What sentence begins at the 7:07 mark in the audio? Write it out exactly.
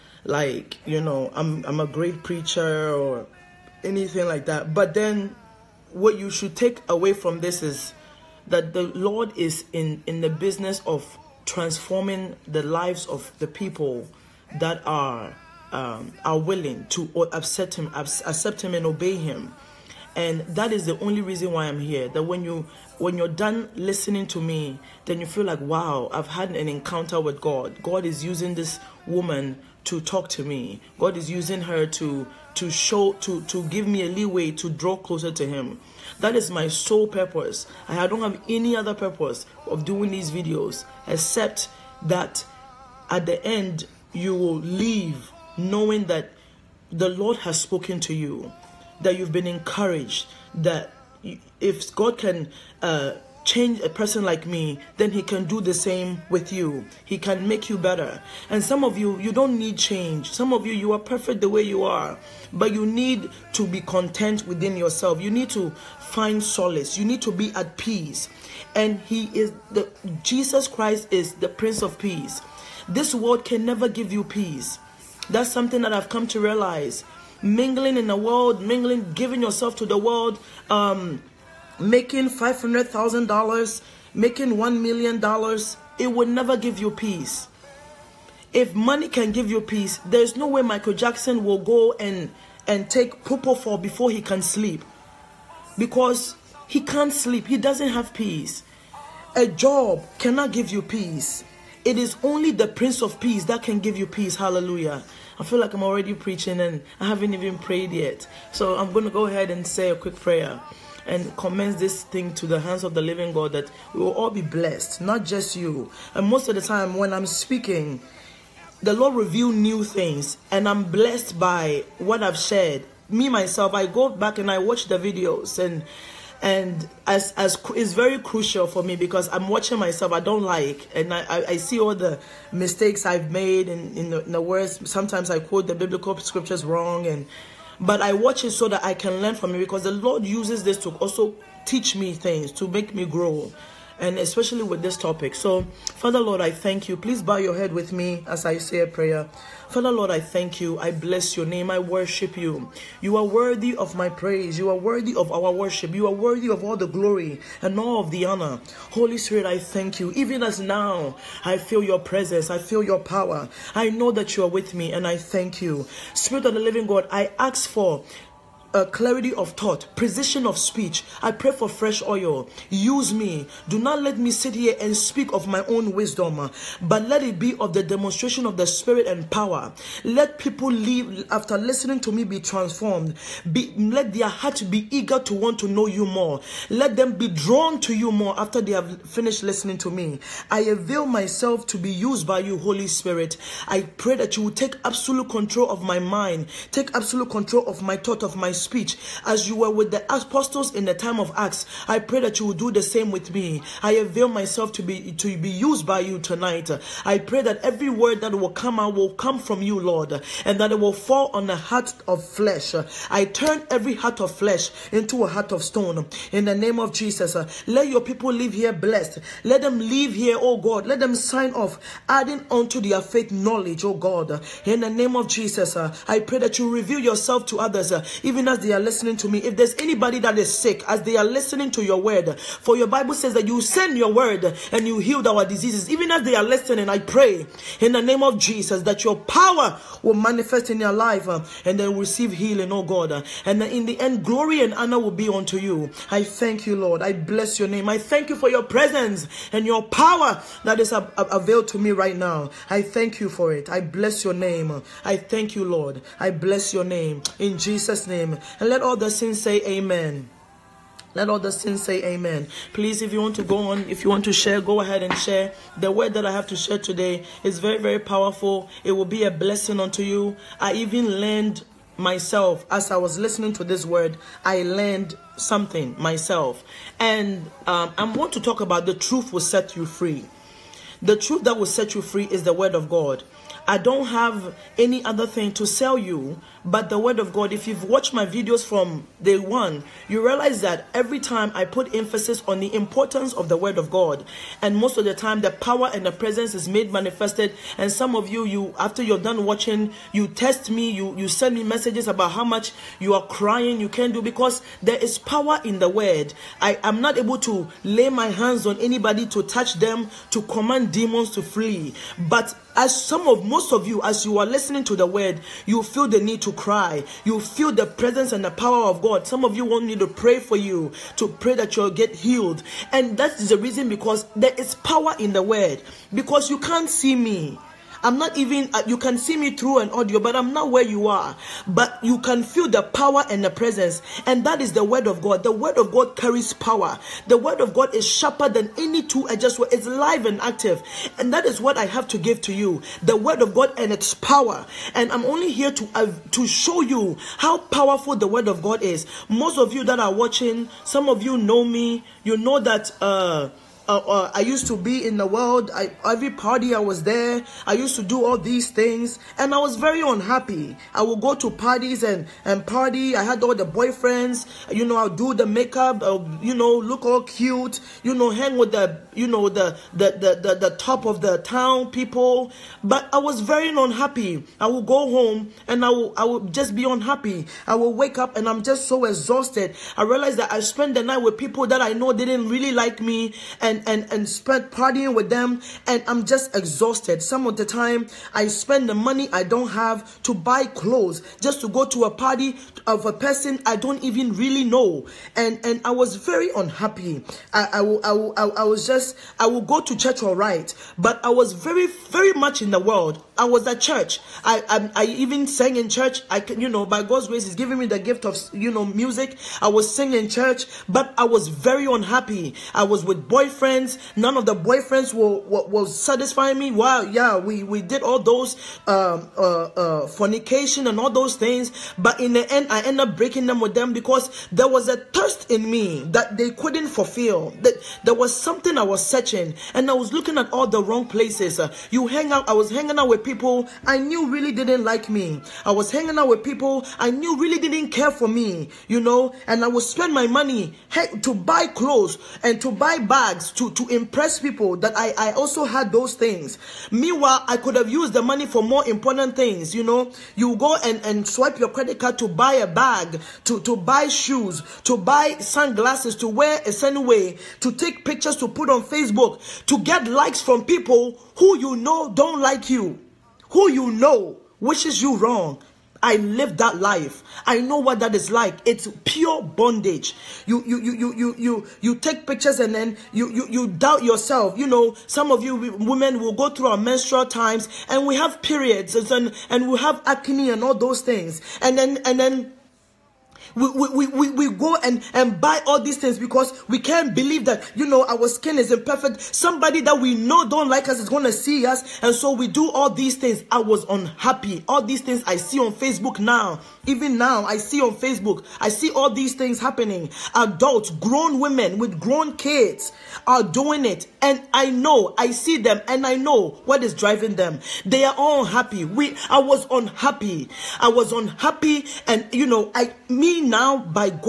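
That there was something I was searching, and I was looking at all the wrong places.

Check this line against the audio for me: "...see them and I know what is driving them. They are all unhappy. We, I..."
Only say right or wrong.
right.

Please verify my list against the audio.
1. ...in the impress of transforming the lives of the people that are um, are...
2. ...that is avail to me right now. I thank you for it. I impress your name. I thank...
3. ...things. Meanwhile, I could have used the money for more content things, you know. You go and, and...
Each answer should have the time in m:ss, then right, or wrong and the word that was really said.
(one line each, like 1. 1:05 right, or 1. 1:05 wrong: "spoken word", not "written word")
1. 0:10 wrong: "business", not "impress"
2. 4:10 wrong: "bless", not "impress"
3. 7:26 wrong: "important", not "content".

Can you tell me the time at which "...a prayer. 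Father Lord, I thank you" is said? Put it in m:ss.
2:28.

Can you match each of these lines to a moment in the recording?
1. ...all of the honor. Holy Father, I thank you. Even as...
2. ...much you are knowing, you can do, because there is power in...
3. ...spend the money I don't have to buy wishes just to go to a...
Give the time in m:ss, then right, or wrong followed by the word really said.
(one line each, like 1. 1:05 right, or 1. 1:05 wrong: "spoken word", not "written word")
1. 2:37 wrong: "Spirit", not "Father"
2. 5:02 wrong: "crying", not "knowing"
3. 6:28 wrong: "clothes", not "wishes".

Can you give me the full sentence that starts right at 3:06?
Let them be drawn to you more after they have finished listening to me.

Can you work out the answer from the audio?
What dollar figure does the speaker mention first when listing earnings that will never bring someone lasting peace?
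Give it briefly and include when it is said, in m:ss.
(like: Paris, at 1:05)
$500,000, at 1:22.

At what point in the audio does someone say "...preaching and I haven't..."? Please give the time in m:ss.
1:46.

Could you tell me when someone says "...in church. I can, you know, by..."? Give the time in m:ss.
6:45.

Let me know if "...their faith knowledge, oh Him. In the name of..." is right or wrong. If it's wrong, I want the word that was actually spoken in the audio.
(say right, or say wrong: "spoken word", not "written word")
wrong: "God", not "Him".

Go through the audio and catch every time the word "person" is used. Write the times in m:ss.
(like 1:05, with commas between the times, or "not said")
0:53, 6:33.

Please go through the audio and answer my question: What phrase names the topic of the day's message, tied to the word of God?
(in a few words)
The truth will set you free.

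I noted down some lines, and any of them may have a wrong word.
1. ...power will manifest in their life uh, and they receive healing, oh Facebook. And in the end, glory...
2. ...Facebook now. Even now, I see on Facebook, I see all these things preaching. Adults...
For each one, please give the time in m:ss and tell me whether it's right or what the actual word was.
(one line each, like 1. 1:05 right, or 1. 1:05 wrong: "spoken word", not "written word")
1. 3:59 wrong: "God", not "Facebook"
2. 8:15 wrong: "happening", not "preaching".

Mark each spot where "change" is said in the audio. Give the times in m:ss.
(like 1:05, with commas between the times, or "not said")
0:53, 0:59.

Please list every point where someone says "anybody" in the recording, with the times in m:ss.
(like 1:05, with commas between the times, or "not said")
3:49, 5:08.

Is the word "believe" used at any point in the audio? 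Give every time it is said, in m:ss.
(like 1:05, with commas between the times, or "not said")
8:07.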